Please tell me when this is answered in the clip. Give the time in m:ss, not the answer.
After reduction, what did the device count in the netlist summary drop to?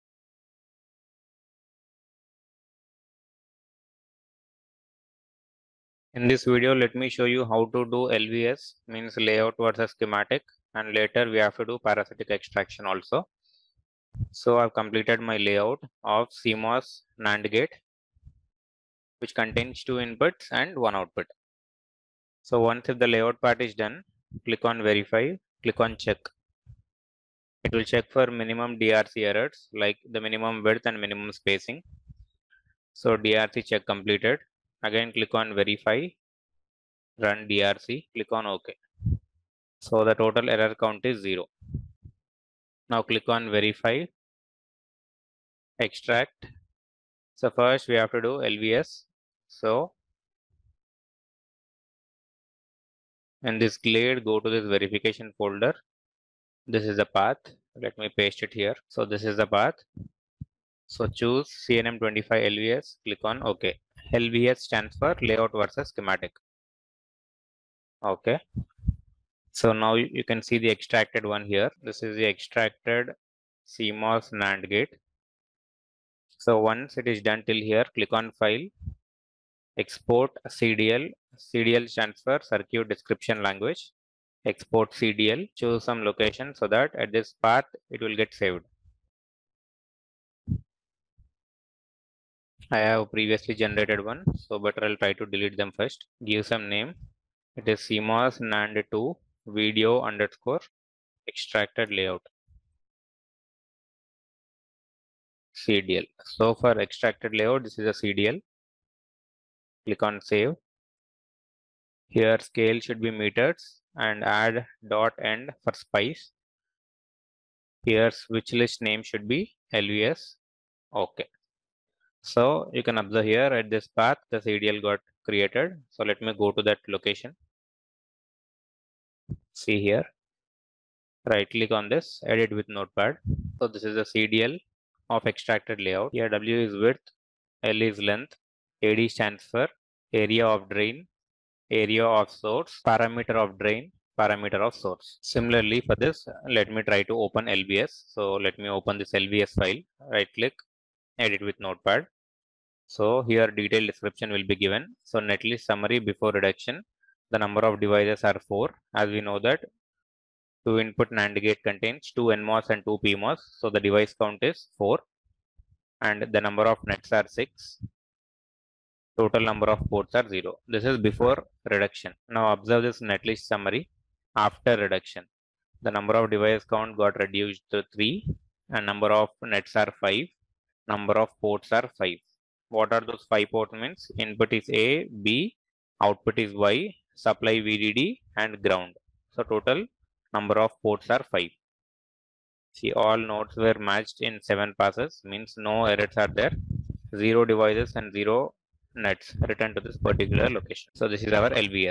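2:57.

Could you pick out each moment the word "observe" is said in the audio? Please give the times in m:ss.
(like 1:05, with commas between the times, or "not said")
2:02, 2:52.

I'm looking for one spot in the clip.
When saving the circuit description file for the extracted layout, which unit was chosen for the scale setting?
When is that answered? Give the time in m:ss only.
1:53.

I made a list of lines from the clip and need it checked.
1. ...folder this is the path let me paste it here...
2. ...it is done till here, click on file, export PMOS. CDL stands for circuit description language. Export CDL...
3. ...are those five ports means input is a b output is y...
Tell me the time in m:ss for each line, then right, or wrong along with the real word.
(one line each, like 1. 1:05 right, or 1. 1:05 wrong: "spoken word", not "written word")
1. 0:55 right
2. 1:16 wrong: "CDL", not "PMOS"
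3. 3:02 right.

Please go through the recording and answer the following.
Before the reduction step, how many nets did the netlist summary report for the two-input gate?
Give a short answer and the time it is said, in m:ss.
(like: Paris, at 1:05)
6, at 2:47.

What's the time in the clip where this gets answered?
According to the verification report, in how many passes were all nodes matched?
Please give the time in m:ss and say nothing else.
3:14.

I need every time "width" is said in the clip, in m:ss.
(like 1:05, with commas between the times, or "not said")
0:30, 2:16.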